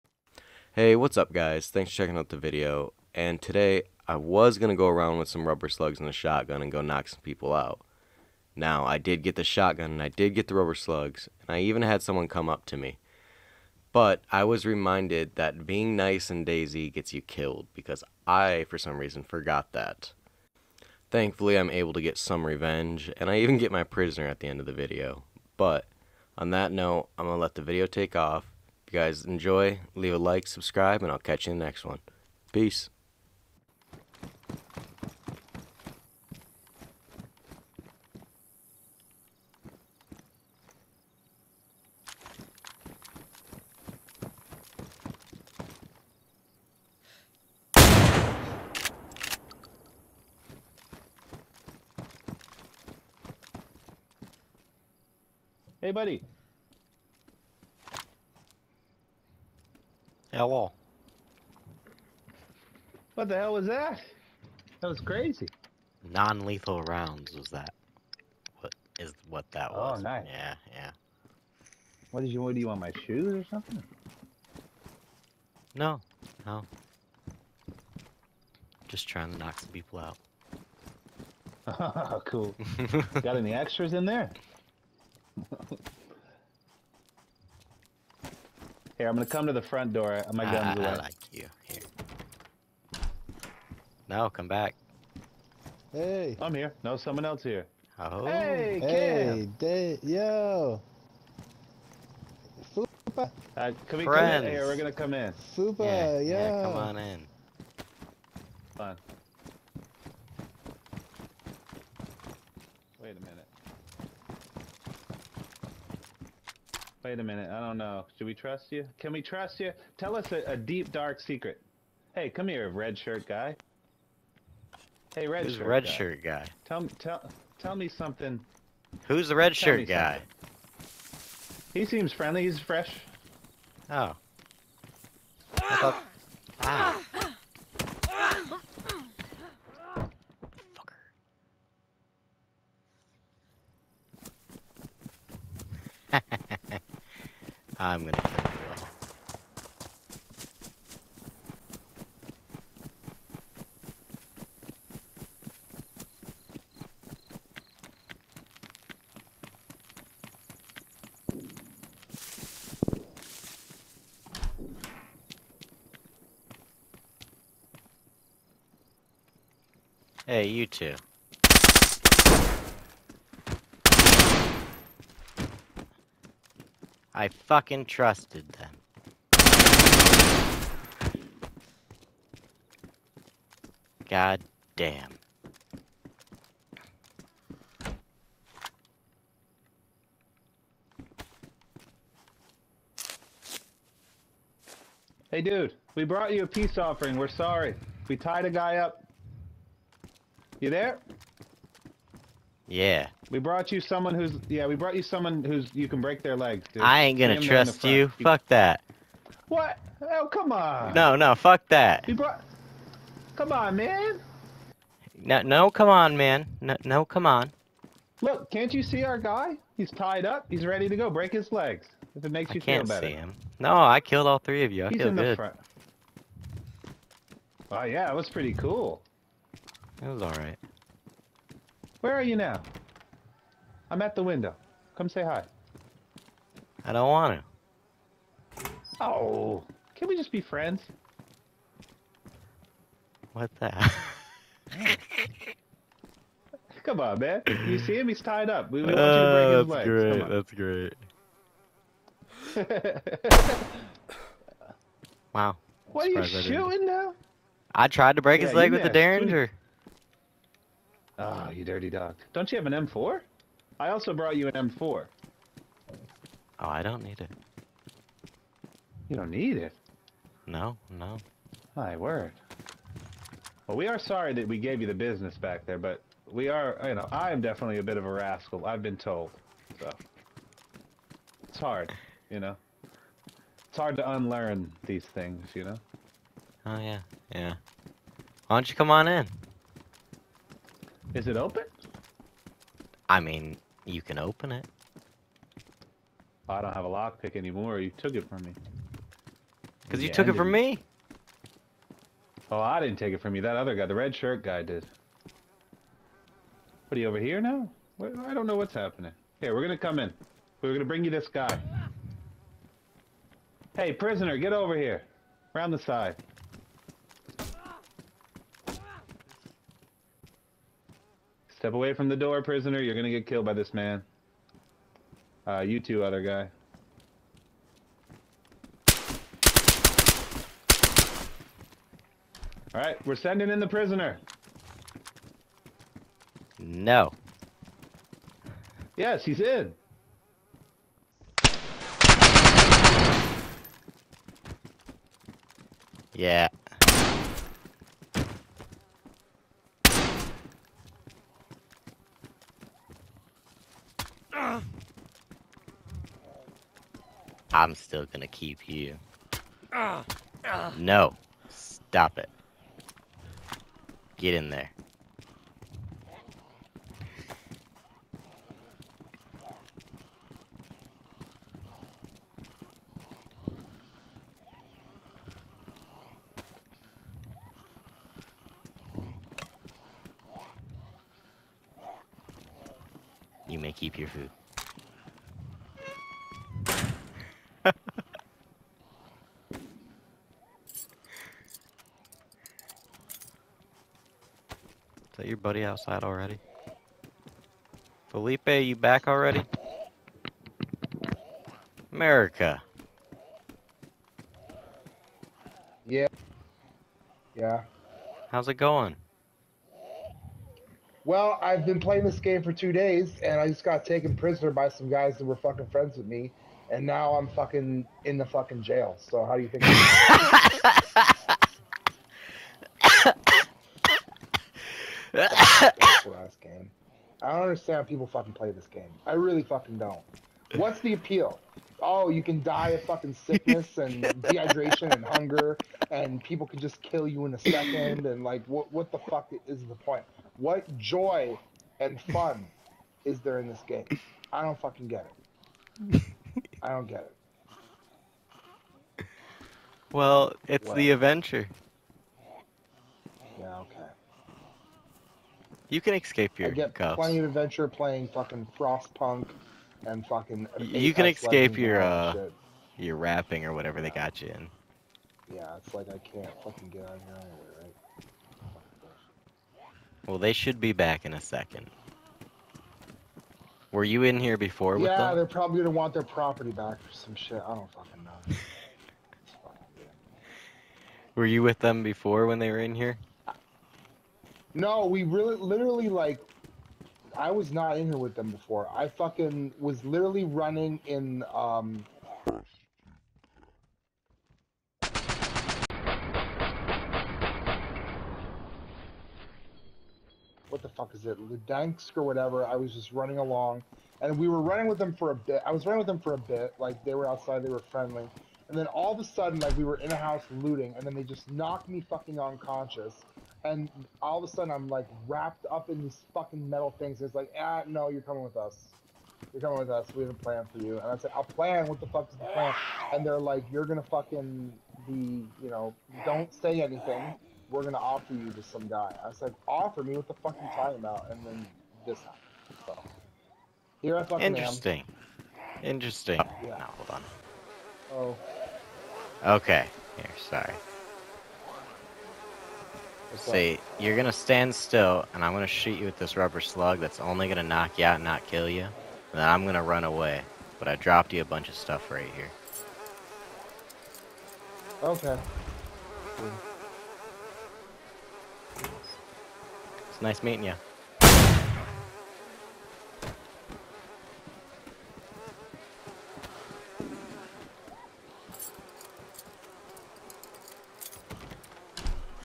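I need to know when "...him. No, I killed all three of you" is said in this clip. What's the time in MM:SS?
03:43.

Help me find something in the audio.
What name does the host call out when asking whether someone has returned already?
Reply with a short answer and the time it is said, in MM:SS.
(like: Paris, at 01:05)
Felipe, at 06:38.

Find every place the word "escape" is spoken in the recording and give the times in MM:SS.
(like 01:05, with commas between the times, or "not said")
07:35, 07:41.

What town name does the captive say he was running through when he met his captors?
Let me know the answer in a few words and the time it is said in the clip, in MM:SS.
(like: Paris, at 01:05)
Ludansk, at 08:21.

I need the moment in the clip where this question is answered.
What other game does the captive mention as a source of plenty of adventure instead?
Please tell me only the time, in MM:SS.
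07:38.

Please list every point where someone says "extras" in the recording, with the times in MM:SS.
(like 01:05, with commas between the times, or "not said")
01:23.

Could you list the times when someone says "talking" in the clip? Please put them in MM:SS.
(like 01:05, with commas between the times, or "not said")
08:50.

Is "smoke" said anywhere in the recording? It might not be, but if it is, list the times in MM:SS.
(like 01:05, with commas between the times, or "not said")
not said.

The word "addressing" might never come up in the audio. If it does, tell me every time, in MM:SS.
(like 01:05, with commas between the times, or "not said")
not said.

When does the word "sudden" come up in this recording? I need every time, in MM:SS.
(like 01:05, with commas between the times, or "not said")
08:29, 08:34.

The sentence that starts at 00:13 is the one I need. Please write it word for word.
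But I was reminded that being nice and DayZ gets you killed, because I, for some reason, forgot that.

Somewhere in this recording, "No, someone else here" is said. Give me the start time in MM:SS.
01:36.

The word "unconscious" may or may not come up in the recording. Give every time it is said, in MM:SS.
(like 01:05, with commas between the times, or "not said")
08:32.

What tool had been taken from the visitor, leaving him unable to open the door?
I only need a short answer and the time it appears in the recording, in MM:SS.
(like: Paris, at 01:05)
Lockpick, at 04:56.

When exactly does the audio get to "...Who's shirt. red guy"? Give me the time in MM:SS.
02:05.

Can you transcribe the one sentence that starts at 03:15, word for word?
Hey dude, we brought you a peace offering.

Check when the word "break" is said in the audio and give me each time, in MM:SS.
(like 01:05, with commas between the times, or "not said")
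03:25, 03:41, 04:10, 04:18.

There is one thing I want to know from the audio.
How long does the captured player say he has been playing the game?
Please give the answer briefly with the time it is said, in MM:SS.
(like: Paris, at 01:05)
2 days, at 06:52.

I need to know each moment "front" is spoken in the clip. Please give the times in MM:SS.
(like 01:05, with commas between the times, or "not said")
01:29, 03:45.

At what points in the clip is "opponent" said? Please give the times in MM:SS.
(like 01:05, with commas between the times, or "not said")
not said.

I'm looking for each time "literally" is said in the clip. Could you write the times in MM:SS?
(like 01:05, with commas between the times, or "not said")
08:05, 08:09.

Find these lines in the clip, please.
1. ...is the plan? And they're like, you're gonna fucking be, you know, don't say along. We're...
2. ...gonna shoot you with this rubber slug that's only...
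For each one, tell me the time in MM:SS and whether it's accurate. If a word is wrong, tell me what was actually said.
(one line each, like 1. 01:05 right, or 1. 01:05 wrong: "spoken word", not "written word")
1. 08:42 wrong: "anything", not "along"
2. 09:05 right.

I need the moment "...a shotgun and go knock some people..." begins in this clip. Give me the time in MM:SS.
00:06.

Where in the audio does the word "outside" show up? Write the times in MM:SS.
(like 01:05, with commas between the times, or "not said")
06:35, 08:27.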